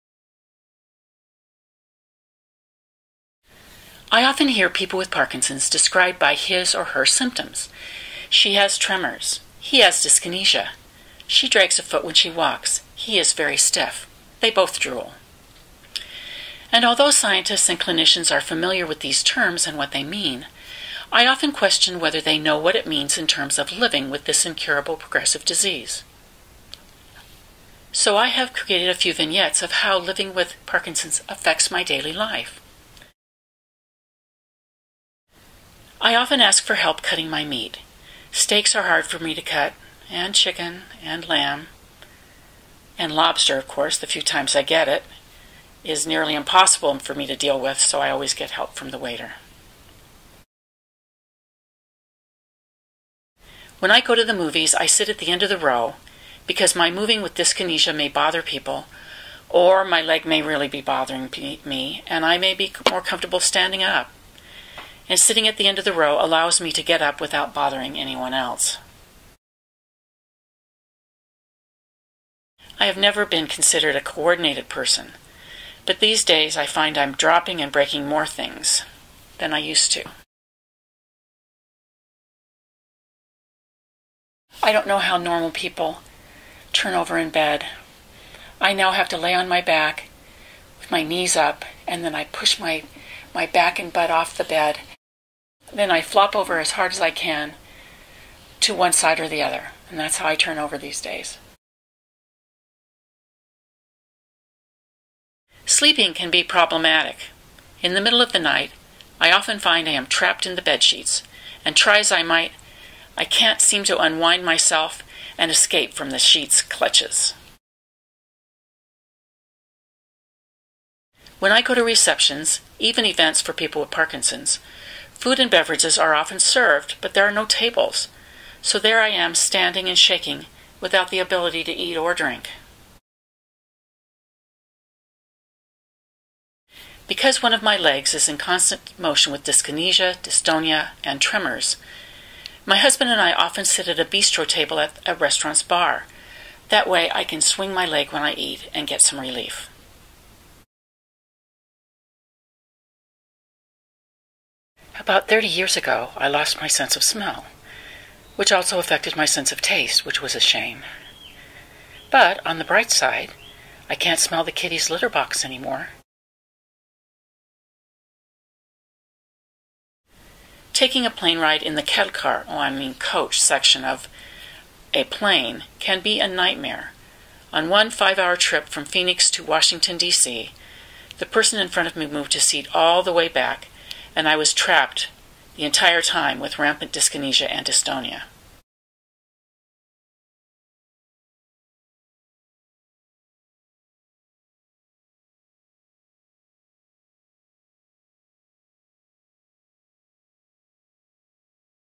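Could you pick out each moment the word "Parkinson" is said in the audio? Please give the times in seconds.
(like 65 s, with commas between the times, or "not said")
5 s, 30 s, 123 s.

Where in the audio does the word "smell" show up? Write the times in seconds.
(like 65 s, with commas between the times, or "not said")
157 s, 164 s.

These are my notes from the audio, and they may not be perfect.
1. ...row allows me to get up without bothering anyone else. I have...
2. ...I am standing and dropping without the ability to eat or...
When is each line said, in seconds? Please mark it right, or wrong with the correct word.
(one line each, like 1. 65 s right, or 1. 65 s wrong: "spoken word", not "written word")
1. 65 s right
2. 129 s wrong: "shaking", not "dropping".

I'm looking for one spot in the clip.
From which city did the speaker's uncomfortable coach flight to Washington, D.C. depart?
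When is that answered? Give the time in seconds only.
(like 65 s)
178 s.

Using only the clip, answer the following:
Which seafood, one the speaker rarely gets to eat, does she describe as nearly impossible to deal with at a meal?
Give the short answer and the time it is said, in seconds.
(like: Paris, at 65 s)
lobster, at 43 s.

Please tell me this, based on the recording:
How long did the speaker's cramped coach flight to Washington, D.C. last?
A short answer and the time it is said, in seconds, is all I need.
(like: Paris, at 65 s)
5 hours, at 177 s.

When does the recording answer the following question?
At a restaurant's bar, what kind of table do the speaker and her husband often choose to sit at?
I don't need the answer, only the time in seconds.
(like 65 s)
144 s.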